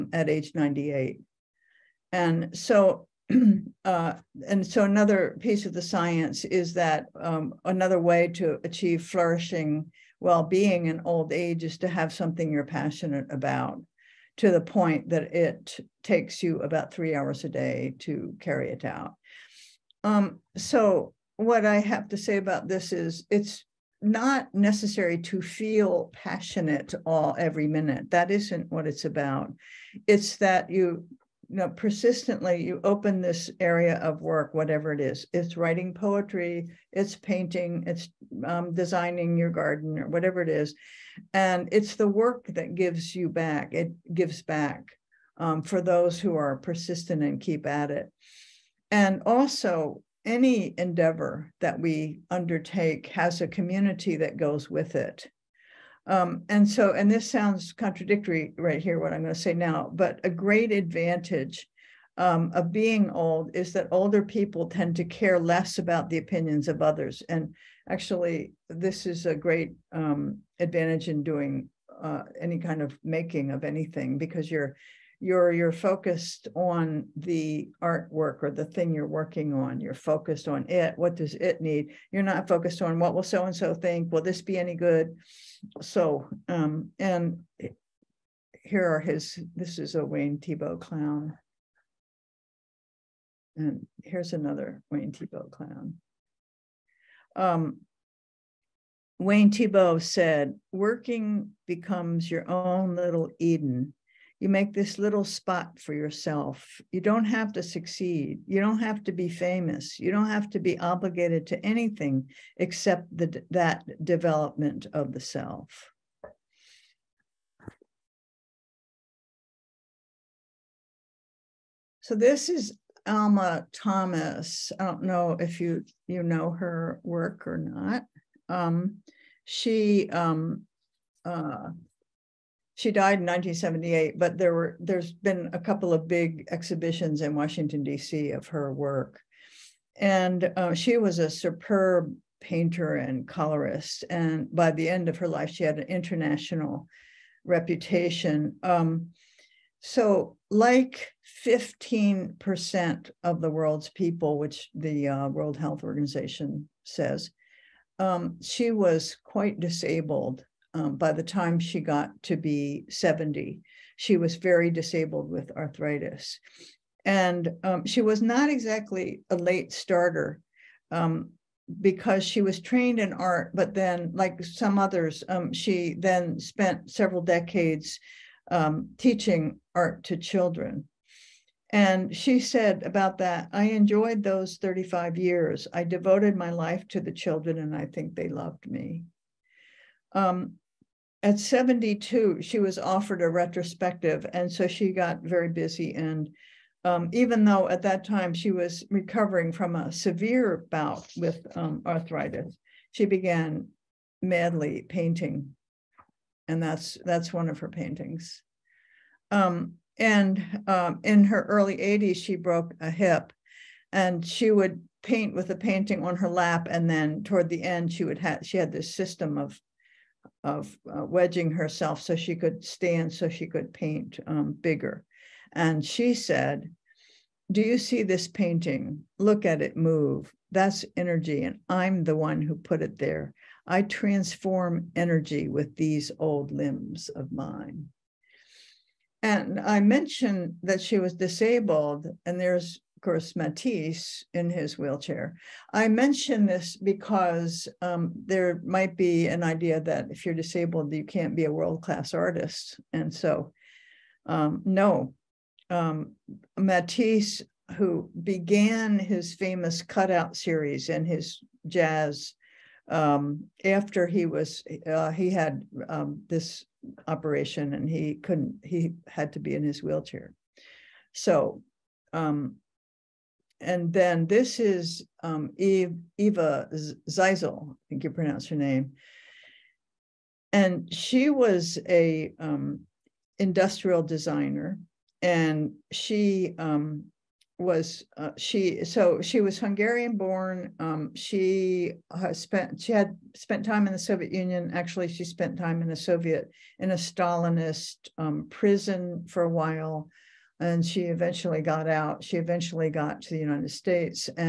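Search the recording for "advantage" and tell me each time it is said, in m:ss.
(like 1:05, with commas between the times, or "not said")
1:00, 1:10.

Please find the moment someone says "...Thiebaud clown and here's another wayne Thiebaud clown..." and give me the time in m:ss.
1:30.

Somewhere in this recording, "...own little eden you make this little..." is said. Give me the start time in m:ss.
1:42.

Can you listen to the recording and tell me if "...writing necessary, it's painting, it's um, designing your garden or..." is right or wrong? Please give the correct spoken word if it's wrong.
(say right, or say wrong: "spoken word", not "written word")
wrong: "poetry", not "necessary".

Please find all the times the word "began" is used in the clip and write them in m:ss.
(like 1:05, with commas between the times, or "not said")
3:23, 4:18.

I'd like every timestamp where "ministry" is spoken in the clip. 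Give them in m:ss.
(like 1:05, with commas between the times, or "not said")
not said.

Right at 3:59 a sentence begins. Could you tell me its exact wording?
And I mentioned that she was disabled, and there's course, Matisse in his wheelchair.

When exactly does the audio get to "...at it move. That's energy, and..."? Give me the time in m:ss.
3:49.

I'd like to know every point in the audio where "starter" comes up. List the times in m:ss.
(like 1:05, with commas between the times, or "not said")
2:49.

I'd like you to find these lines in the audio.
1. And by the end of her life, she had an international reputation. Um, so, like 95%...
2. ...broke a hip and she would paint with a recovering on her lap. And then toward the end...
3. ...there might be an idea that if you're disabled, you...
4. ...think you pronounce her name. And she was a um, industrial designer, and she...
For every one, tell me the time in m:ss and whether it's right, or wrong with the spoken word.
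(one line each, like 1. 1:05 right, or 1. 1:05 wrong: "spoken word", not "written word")
1. 2:24 wrong: "15", not "95"
2. 3:32 wrong: "painting", not "recovering"
3. 4:08 right
4. 4:37 right.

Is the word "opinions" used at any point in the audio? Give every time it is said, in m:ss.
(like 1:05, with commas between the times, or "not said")
1:06.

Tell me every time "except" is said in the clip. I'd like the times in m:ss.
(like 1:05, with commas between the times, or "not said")
1:52.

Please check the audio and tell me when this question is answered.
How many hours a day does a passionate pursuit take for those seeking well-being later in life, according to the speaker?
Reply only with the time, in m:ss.
0:16.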